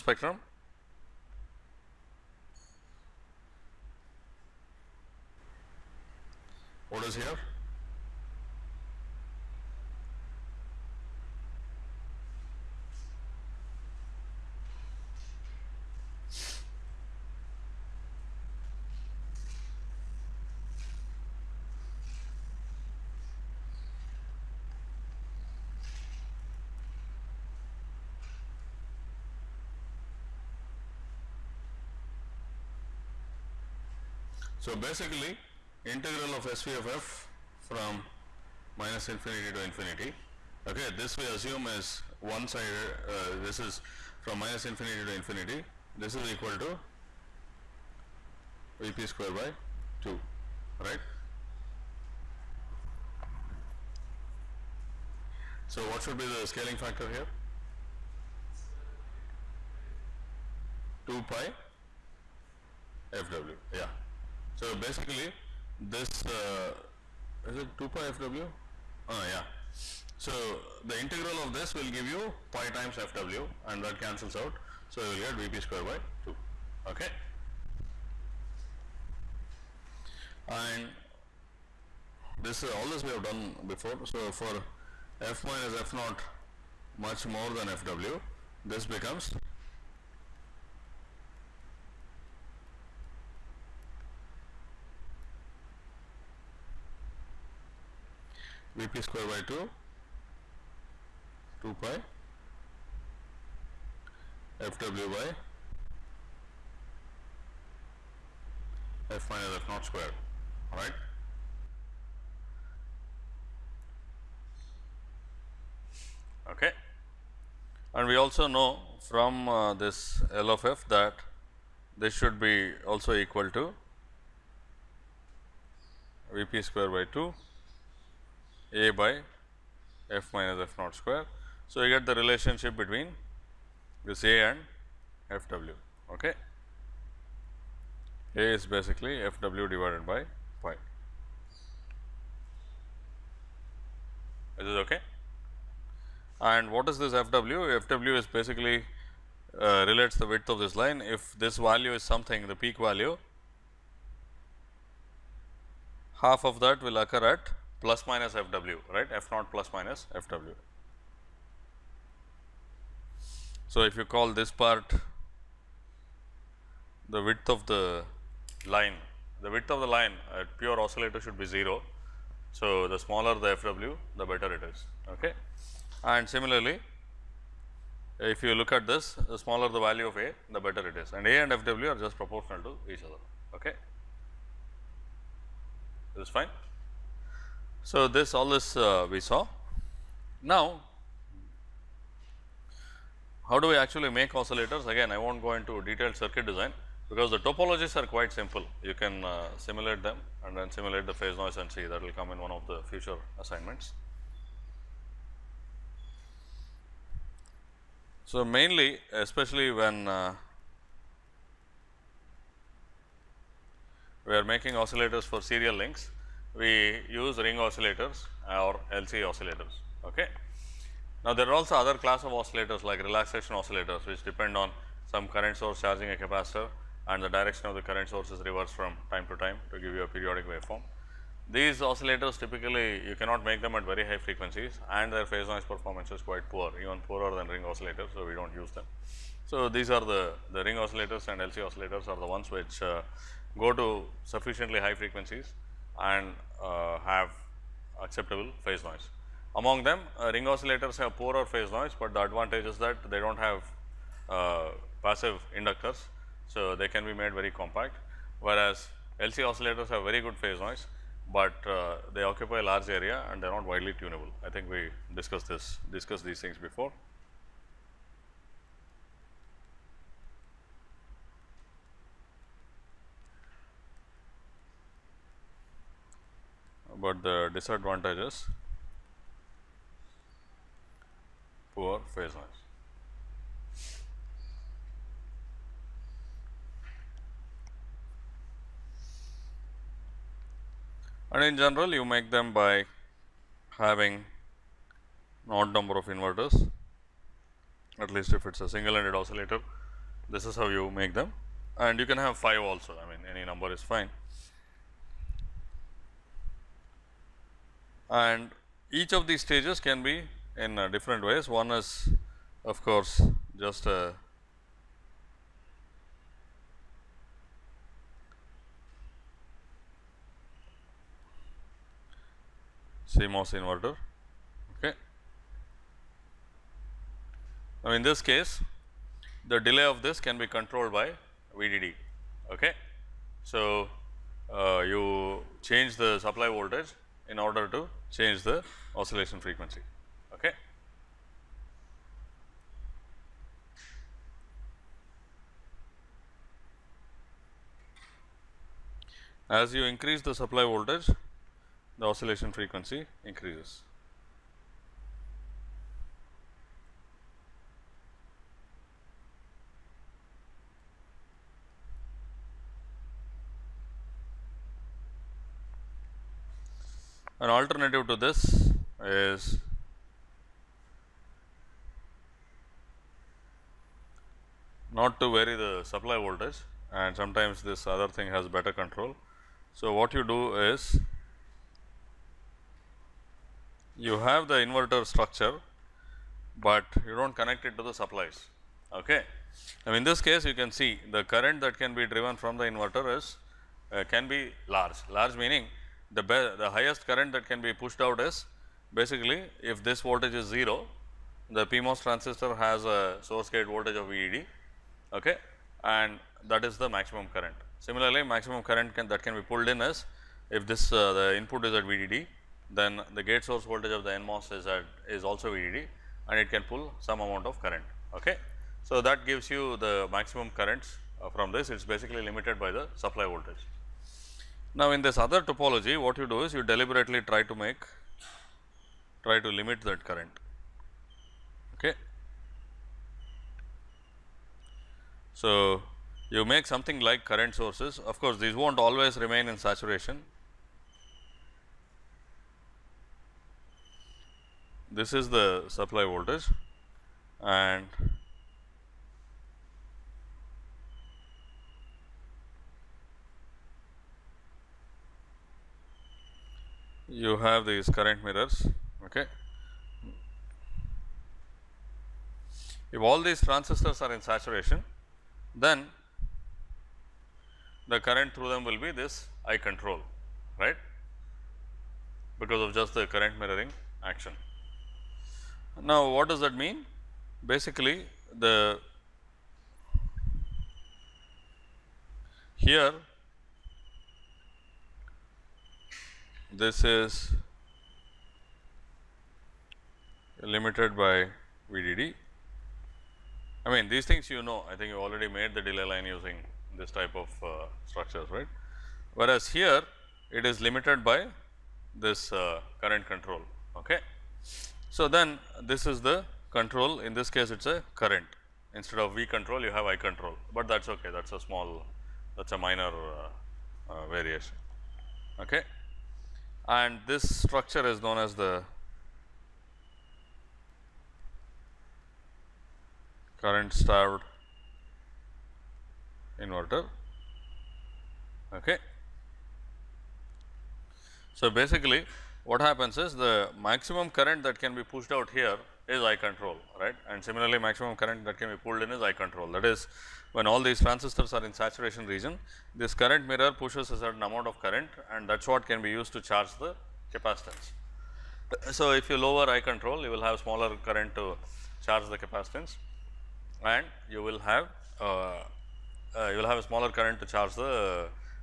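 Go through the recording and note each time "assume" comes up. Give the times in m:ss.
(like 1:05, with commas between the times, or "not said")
0:41.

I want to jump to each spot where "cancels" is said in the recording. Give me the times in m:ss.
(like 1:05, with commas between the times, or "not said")
1:13.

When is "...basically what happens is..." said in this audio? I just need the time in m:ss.
8:51.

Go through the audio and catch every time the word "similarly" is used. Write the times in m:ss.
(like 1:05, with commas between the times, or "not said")
2:56, 6:47, 8:57.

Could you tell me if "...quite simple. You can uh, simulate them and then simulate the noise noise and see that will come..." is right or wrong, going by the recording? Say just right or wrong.
wrong.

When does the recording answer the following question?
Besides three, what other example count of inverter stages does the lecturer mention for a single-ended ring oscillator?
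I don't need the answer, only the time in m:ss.
5:02.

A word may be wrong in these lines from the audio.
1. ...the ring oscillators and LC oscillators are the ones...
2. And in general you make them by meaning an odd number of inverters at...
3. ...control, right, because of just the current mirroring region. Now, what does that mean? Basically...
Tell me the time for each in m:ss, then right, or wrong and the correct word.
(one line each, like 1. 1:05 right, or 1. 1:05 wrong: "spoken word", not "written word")
1. 4:00 right
2. 4:51 wrong: "having", not "meaning"
3. 7:49 wrong: "action", not "region".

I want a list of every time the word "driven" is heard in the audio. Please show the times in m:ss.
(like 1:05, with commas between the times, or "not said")
6:32.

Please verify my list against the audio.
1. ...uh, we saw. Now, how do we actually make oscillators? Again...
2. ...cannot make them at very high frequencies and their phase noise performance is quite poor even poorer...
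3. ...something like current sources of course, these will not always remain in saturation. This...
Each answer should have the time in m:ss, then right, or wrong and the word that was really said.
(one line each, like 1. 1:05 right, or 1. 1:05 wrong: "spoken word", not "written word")
1. 3:08 right
2. 3:53 right
3. 7:16 right.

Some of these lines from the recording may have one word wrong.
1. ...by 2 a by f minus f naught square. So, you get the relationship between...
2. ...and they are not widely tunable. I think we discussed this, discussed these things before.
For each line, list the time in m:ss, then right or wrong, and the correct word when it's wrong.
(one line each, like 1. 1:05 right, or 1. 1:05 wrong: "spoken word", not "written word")
1. 2:06 right
2. 4:23 right.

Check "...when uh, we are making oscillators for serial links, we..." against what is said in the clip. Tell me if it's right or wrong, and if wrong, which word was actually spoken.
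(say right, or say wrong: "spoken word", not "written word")
right.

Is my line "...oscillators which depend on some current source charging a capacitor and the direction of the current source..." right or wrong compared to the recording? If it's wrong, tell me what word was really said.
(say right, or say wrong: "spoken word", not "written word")
right.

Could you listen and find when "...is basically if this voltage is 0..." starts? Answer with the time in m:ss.
6:38.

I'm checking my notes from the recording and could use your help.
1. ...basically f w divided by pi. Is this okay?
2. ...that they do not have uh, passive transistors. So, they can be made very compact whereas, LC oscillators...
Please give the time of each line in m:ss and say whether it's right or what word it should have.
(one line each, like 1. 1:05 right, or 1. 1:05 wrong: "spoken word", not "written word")
1. 2:18 right
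2. 4:12 wrong: "inductors", not "transistors".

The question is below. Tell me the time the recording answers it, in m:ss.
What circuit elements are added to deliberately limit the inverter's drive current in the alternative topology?
7:37.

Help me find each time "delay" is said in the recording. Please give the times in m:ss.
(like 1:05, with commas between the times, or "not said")
5:29, 8:15.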